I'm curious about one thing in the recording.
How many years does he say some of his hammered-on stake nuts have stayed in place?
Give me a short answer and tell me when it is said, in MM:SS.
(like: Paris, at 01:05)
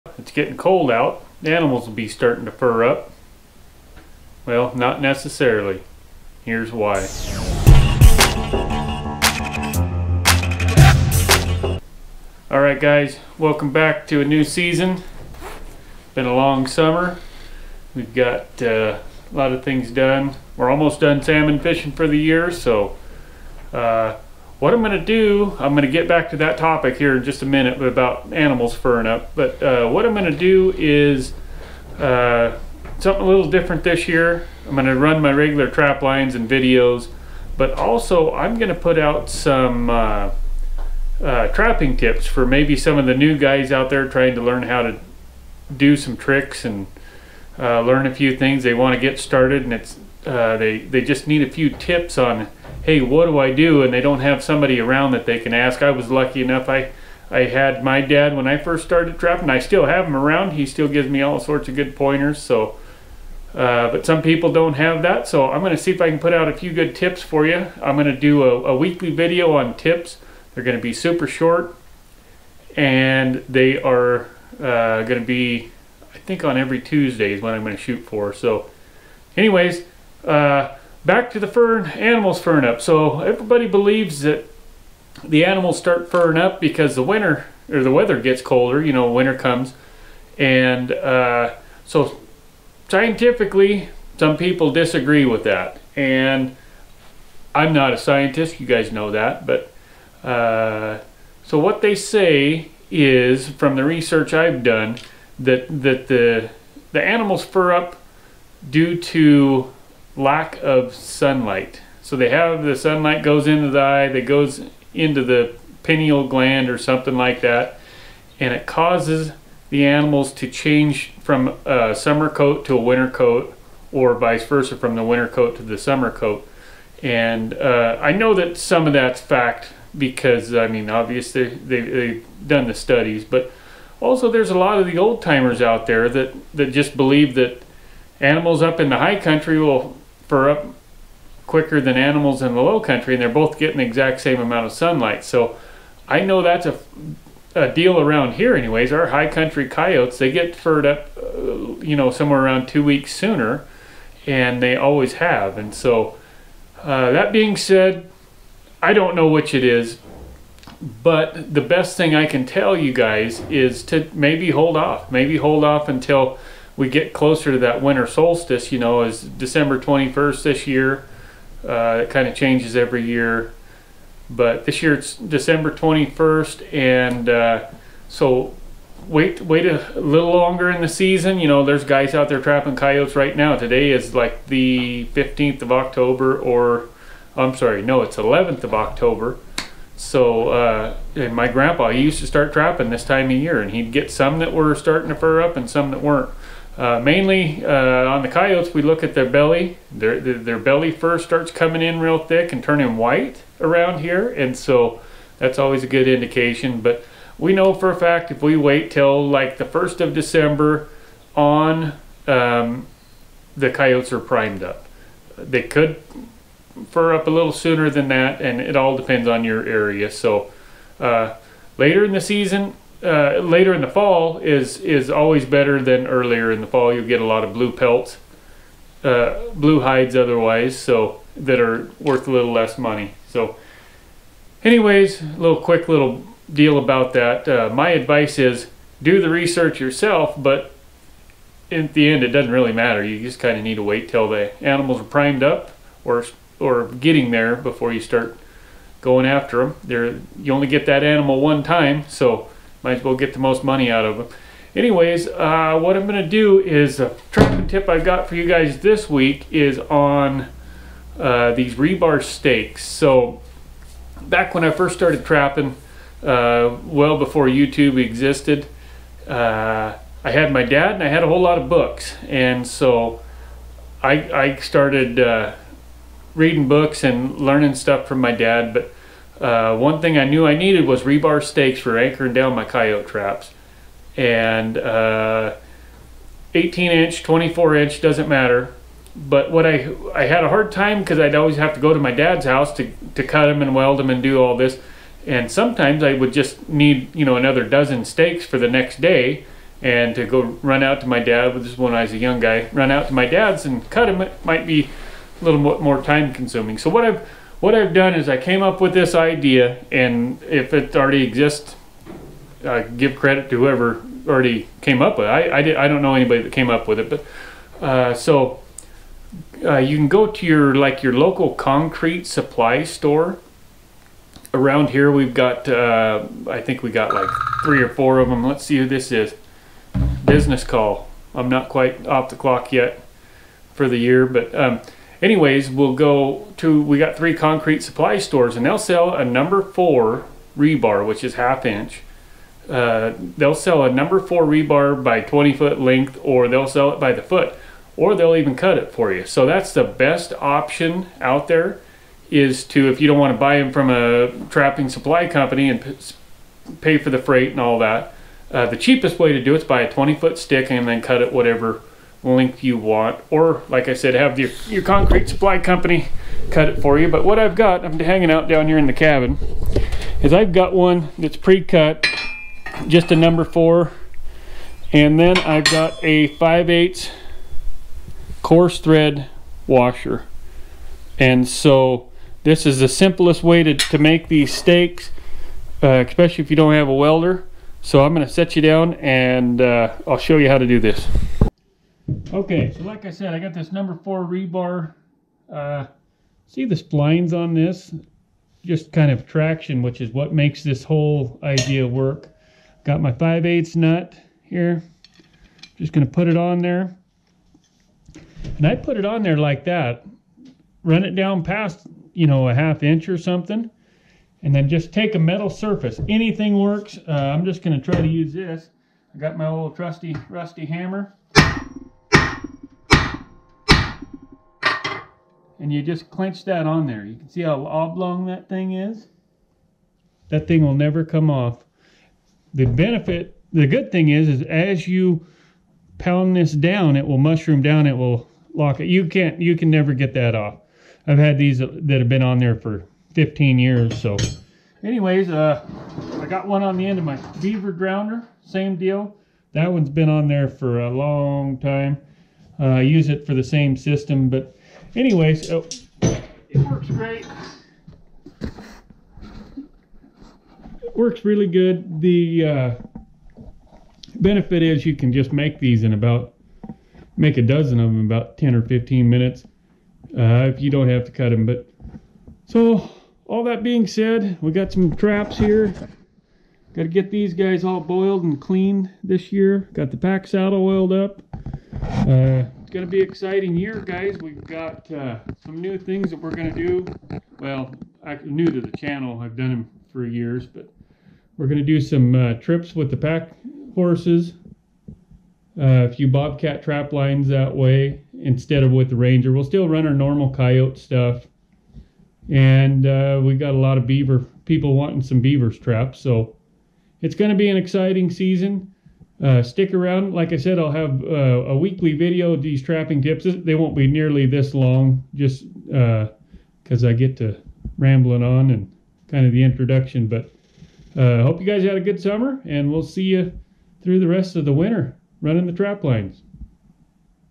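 15 years, at 07:23.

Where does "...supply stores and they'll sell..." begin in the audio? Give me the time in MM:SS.
05:37.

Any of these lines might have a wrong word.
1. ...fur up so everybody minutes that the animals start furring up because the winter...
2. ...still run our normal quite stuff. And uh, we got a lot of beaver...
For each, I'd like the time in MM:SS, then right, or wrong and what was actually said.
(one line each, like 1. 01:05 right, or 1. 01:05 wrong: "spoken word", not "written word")
1. 01:22 wrong: "believes", not "minutes"
2. 08:19 wrong: "coyote", not "quite".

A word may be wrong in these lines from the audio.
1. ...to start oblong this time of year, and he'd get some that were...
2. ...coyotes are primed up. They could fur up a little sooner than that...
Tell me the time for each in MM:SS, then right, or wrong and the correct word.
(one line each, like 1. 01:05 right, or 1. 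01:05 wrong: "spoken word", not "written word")
1. 03:12 wrong: "trapping", not "oblong"
2. 03:33 right.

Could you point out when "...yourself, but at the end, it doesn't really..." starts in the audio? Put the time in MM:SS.
03:59.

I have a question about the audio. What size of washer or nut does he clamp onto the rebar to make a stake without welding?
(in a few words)
5/8 coarse thread.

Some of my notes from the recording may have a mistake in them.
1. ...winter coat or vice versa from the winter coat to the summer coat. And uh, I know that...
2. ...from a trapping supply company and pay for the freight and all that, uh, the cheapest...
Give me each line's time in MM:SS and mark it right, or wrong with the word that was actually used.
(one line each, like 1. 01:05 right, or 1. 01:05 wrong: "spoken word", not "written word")
1. 02:02 right
2. 05:53 right.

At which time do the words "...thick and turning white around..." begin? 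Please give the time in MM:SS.
03:22.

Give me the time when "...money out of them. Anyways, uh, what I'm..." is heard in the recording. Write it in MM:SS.
04:13.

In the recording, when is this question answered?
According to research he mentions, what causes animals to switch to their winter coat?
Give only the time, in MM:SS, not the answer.
01:50.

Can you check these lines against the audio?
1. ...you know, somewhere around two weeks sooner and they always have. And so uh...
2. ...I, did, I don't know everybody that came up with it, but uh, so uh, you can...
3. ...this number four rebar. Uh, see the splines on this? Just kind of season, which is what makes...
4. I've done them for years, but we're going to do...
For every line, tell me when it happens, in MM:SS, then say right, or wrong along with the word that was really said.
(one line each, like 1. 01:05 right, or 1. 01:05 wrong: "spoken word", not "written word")
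1. 02:31 right
2. 05:15 wrong: "anybody", not "everybody"
3. 06:33 wrong: "traction", not "season"
4. 08:09 right.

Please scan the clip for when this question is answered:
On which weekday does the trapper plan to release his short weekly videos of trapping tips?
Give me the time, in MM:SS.
01:16.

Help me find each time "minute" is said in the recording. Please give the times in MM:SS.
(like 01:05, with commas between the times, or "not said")
00:27, 07:49.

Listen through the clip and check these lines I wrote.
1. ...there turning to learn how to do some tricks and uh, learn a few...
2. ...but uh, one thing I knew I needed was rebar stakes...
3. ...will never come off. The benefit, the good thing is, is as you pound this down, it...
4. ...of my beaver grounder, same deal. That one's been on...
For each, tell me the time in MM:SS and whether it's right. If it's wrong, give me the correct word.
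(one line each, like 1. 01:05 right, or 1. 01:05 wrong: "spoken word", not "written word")
1. 00:43 wrong: "trying", not "turning"
2. 04:38 right
3. 07:10 right
4. 07:26 right.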